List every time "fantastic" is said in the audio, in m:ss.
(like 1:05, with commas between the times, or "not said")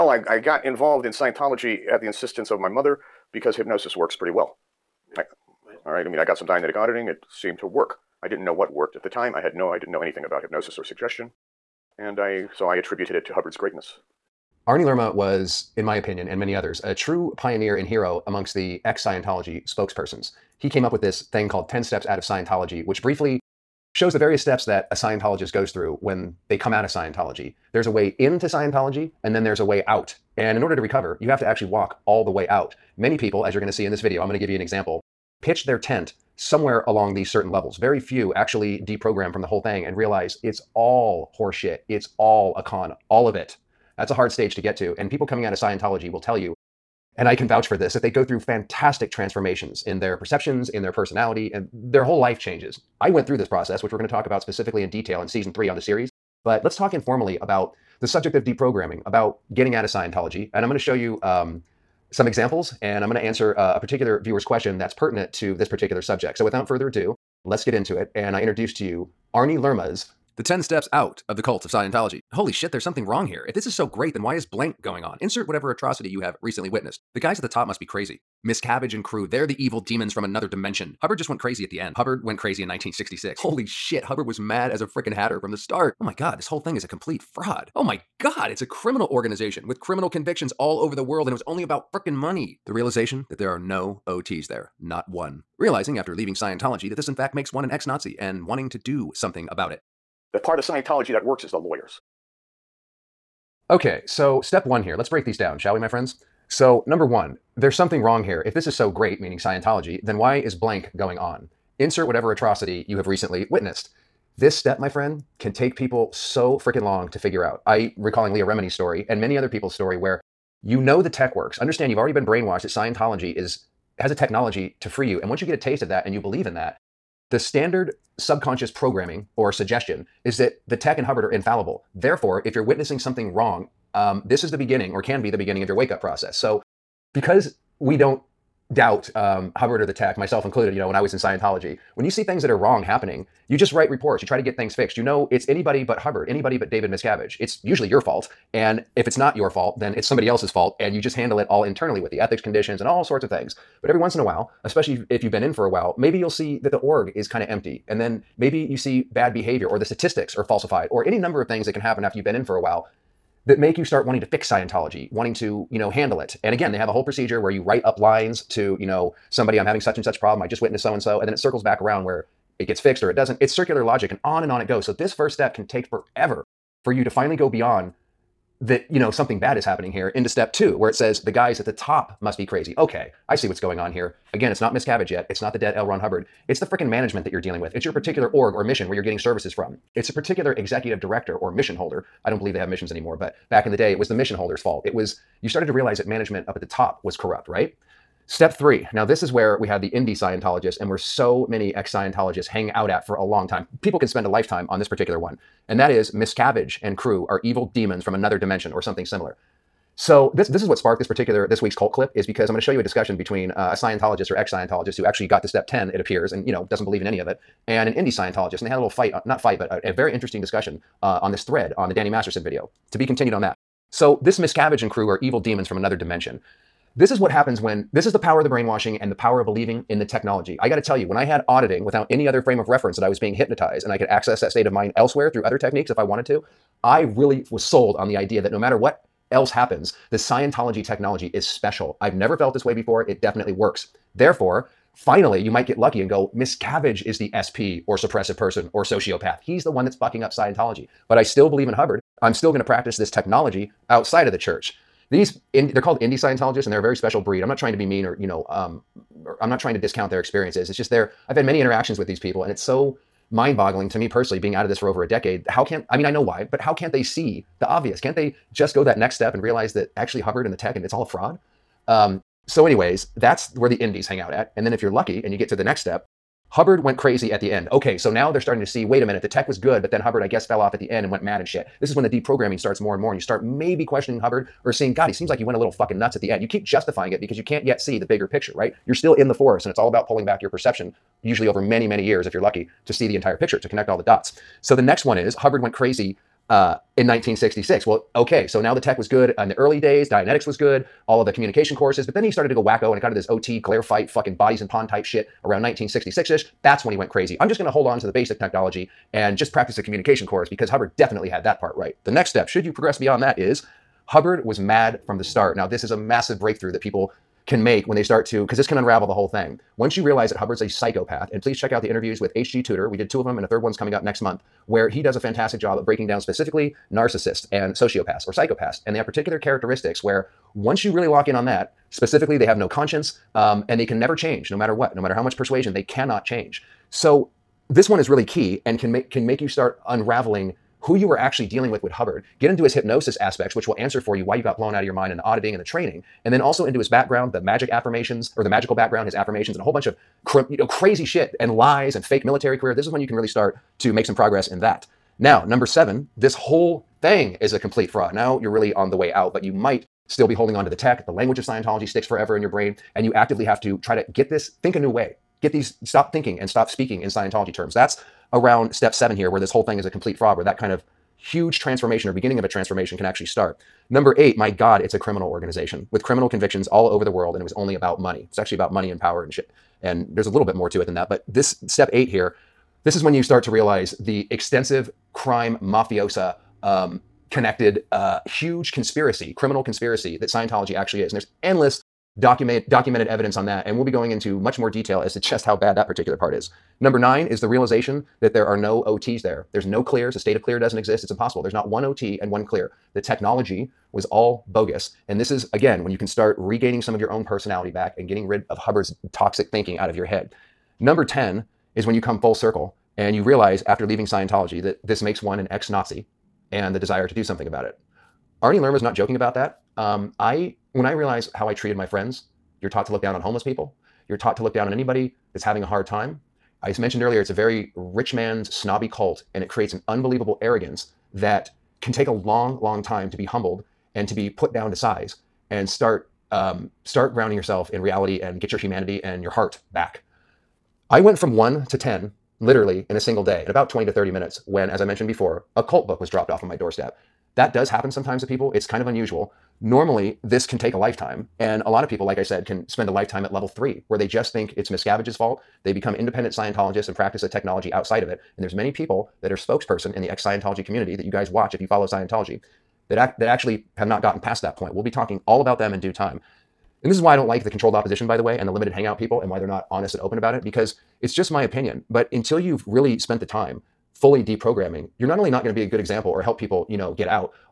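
0:48, 5:25.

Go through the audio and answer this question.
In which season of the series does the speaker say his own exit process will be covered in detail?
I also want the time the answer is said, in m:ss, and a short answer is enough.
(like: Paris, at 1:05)
season three, at 0:55.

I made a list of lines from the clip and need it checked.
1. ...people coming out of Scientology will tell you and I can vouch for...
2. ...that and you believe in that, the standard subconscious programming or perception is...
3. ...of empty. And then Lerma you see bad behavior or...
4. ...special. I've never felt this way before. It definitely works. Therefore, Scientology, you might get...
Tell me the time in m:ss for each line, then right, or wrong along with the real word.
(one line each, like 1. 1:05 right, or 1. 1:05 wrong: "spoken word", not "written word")
1. 0:45 right
2. 2:05 wrong: "suggestion", not "perception"
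3. 2:37 wrong: "Maybe", not "Lerma"
4. 4:01 wrong: "Finally", not "Scientology".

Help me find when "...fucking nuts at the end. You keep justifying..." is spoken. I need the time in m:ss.
4:45.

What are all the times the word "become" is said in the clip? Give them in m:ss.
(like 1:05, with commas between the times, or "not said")
7:35.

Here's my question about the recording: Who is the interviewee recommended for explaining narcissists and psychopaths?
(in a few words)
H.G. Tudor.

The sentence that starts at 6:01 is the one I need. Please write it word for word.
The language of Scientology sticks forever in your brain, and you actively have to try to get this, think a new way.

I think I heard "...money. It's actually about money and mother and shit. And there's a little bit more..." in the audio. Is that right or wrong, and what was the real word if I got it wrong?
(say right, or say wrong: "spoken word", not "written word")
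wrong: "power", not "mother".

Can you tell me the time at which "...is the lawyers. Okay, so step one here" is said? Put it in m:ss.
1:41.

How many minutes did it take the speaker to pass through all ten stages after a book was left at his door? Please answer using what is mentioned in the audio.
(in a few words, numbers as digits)
20 to 30 minutes.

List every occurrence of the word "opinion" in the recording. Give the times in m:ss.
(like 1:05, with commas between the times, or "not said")
0:15, 7:51.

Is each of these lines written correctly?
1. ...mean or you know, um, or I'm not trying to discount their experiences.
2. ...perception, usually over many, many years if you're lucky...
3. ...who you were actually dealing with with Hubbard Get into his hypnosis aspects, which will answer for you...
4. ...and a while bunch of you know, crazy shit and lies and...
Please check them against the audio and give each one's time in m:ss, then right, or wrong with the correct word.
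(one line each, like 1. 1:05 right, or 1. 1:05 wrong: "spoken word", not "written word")
1. 4:17 right
2. 4:50 right
3. 5:40 right
4. 5:49 wrong: "whole", not "while".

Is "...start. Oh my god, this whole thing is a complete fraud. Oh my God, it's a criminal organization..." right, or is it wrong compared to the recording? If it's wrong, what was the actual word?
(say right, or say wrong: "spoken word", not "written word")
right.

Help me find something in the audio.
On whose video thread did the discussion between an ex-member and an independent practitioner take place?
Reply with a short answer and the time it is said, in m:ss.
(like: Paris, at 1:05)
Danny Masterson, at 3:41.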